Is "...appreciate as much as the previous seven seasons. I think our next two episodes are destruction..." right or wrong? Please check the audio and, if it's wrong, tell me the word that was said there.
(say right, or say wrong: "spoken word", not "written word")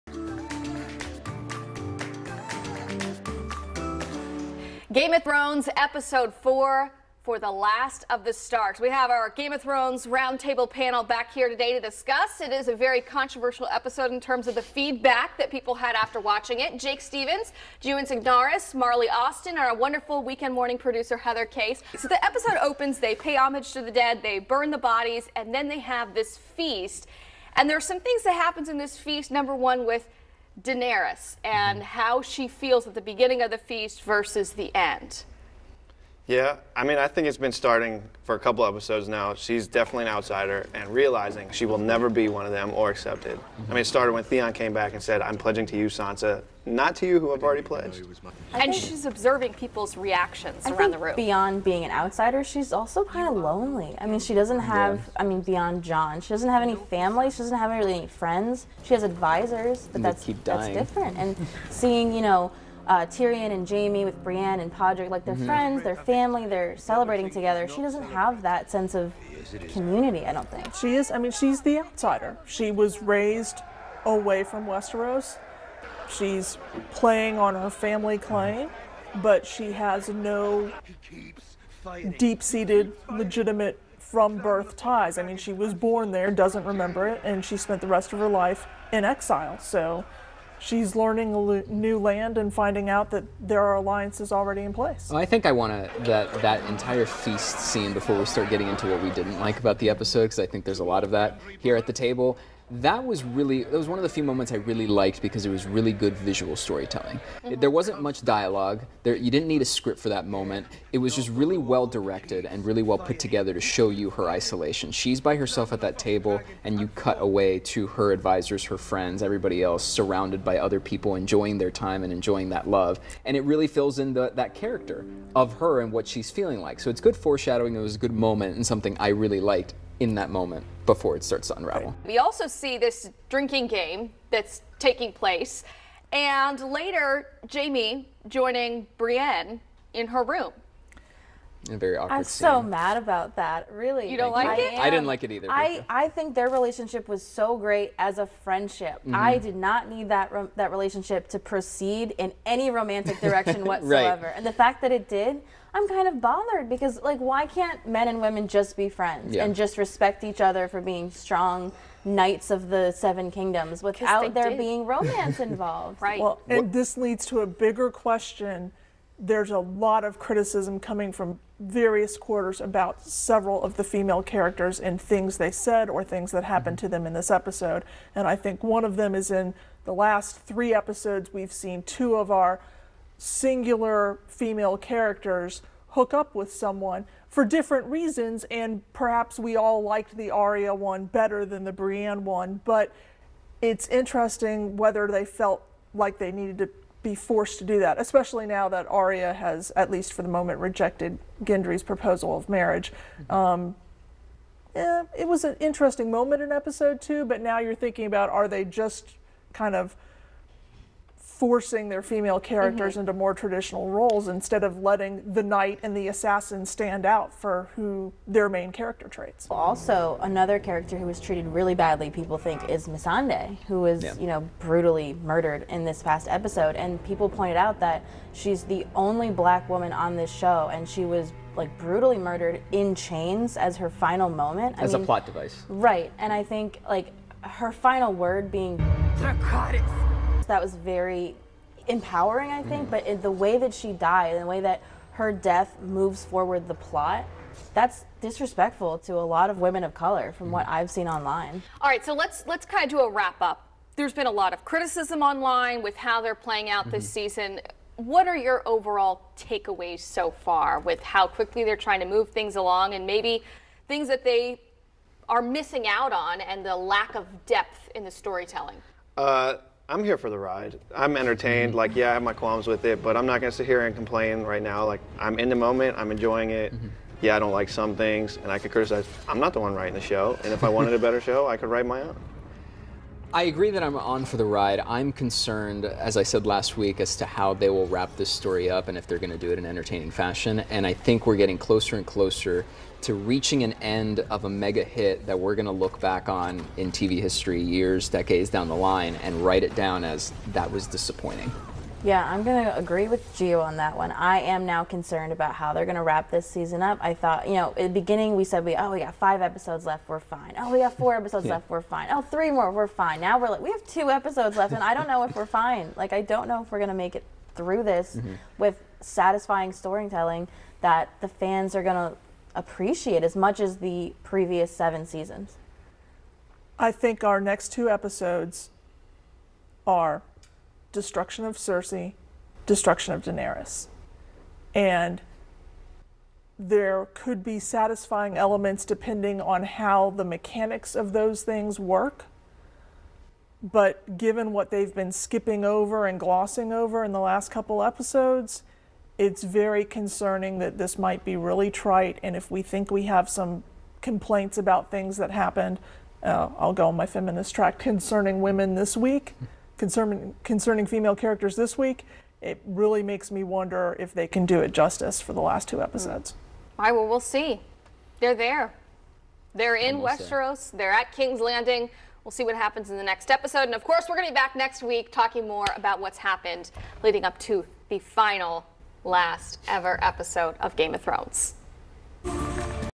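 right.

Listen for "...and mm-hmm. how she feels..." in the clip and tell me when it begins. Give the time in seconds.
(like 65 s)
31 s.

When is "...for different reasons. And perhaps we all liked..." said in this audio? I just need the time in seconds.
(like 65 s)
187 s.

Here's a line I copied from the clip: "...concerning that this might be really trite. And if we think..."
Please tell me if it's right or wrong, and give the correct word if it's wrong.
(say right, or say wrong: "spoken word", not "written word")
right.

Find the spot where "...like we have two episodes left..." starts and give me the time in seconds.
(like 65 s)
313 s.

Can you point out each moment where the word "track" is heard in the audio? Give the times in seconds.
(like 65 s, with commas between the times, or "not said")
357 s.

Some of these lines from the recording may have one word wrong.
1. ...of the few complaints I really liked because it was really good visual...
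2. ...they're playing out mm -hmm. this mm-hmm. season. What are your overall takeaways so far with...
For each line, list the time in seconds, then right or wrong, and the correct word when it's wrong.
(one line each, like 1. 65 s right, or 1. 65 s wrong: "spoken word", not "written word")
1. 103 s wrong: "moments", not "complaints"
2. 256 s right.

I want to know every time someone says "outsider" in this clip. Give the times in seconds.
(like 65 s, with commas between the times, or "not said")
40 s, 51 s, 71 s.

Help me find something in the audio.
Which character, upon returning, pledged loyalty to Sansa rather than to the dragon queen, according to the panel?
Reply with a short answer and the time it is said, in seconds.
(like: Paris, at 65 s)
Theon, at 44 s.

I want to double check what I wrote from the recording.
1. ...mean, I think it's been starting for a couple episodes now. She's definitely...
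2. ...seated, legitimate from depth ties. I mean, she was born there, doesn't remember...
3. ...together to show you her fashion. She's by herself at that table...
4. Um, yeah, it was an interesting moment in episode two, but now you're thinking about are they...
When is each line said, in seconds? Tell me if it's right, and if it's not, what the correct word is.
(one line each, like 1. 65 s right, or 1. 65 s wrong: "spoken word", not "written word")
1. 36 s right
2. 82 s wrong: "birth", not "depth"
3. 113 s wrong: "isolation", not "fashion"
4. 203 s right.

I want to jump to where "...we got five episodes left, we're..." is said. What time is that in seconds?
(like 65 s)
308 s.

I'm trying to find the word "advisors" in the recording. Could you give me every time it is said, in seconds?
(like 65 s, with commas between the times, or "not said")
59 s, 118 s.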